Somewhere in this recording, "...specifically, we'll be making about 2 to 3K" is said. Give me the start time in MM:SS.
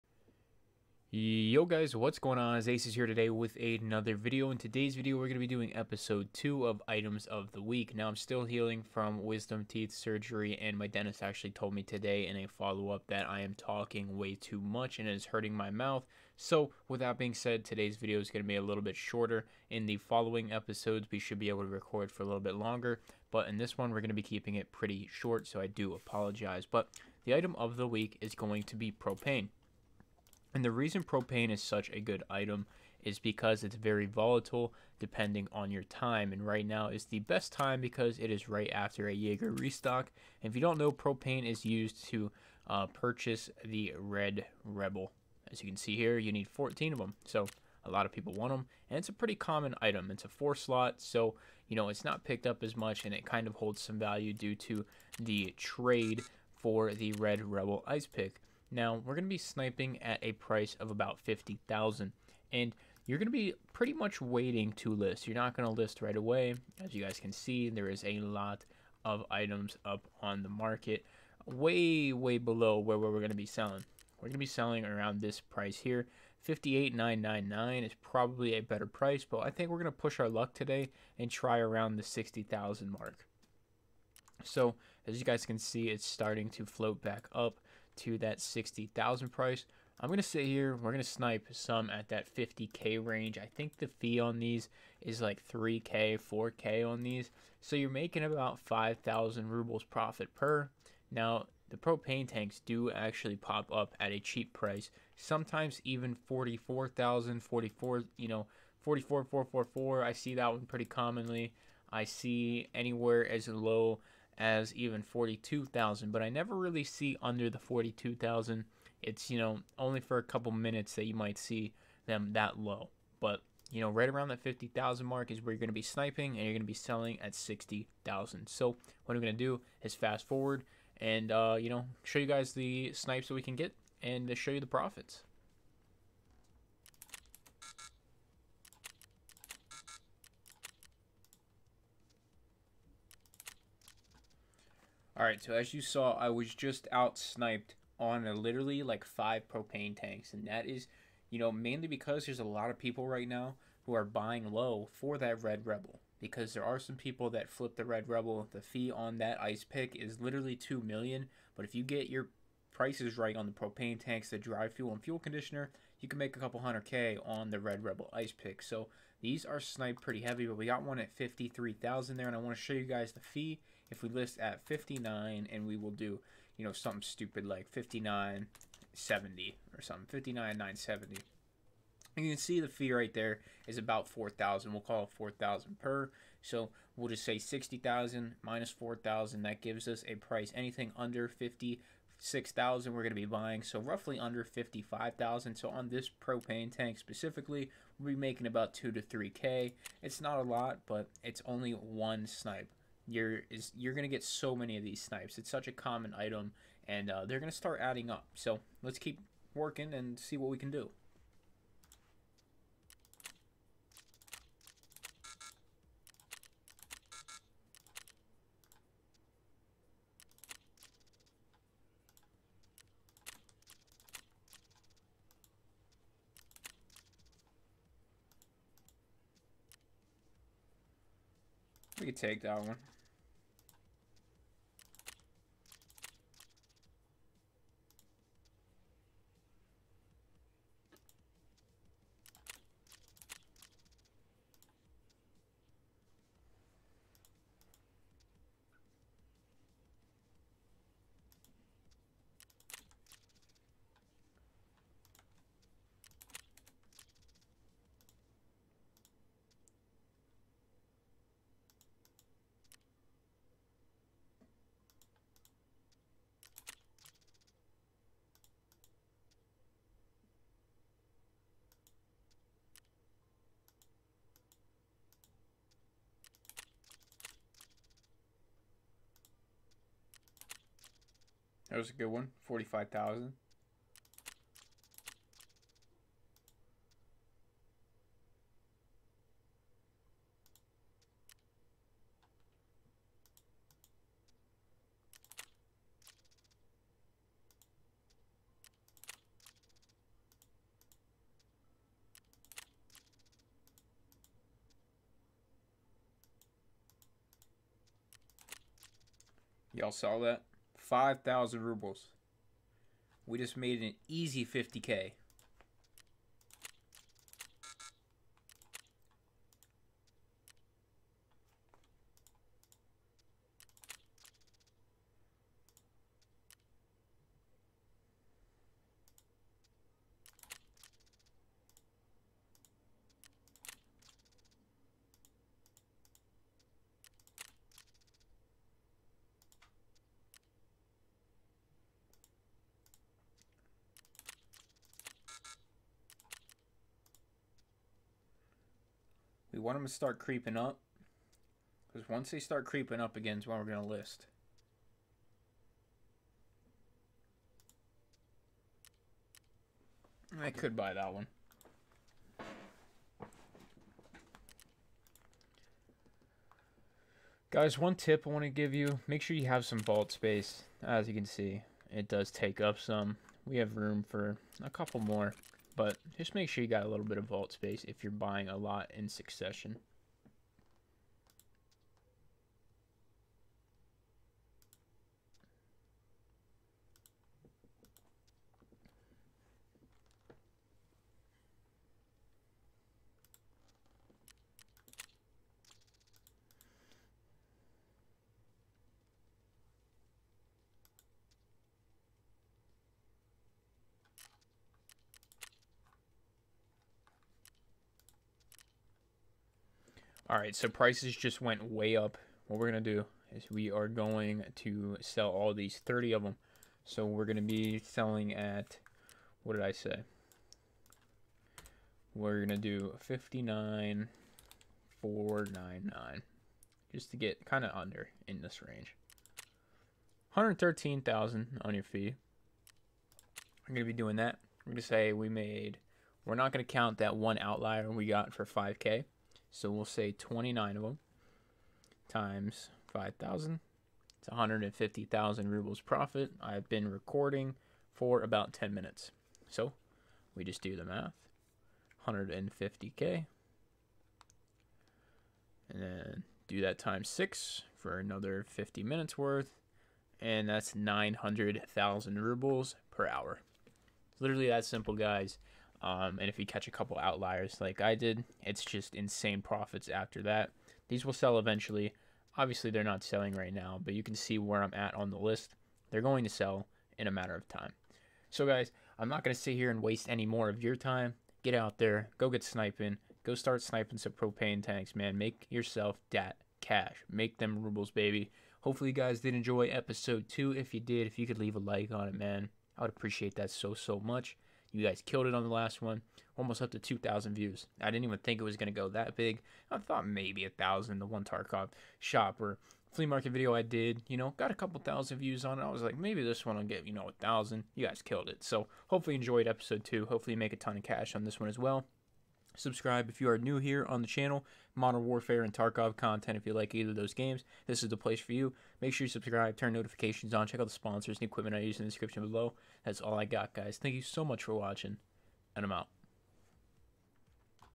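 03:16.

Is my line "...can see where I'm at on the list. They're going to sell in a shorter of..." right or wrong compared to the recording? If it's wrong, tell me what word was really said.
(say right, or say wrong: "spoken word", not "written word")
wrong: "matter", not "shorter".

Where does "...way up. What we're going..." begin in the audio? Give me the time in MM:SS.
06:51.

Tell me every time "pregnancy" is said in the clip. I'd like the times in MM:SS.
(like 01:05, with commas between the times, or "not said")
not said.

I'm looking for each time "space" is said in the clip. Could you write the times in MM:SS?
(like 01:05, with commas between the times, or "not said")
06:10, 06:17.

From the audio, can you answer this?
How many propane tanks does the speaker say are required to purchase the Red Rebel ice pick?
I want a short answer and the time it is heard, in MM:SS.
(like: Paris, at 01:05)
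14, at 00:46.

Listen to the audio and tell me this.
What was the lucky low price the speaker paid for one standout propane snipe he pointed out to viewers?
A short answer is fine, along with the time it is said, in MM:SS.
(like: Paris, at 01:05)
45,000, at 04:42.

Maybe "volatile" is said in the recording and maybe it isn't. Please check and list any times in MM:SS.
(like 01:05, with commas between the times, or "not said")
00:34.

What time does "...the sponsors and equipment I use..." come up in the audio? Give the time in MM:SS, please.
08:40.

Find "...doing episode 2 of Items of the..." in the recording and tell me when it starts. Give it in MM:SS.
00:05.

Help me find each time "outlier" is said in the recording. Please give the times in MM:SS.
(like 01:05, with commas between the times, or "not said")
07:17, 07:46.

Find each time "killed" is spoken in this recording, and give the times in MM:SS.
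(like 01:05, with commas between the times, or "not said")
08:15, 08:28.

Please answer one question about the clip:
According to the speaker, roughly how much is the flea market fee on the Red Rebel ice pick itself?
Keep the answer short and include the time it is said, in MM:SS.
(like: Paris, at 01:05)
2 million, at 02:40.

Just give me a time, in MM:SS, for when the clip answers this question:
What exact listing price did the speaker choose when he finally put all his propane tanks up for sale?
07:03.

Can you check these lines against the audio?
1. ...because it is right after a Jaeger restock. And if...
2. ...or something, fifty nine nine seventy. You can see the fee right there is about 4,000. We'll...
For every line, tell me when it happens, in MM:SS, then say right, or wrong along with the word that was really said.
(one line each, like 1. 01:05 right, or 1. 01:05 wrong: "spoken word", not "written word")
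1. 00:37 right
2. 02:59 right.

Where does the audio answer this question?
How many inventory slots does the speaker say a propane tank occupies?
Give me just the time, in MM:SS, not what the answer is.
00:50.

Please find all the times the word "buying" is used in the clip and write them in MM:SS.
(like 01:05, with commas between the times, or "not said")
02:34, 03:13, 06:18.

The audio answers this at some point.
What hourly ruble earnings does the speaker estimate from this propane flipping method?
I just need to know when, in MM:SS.
07:40.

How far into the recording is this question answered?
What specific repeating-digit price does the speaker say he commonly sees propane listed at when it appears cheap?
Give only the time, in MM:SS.
01:48.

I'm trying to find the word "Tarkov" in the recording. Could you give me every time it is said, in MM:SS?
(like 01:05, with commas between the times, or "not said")
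08:21, 08:35.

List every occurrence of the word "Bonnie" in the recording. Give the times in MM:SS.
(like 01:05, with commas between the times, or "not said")
not said.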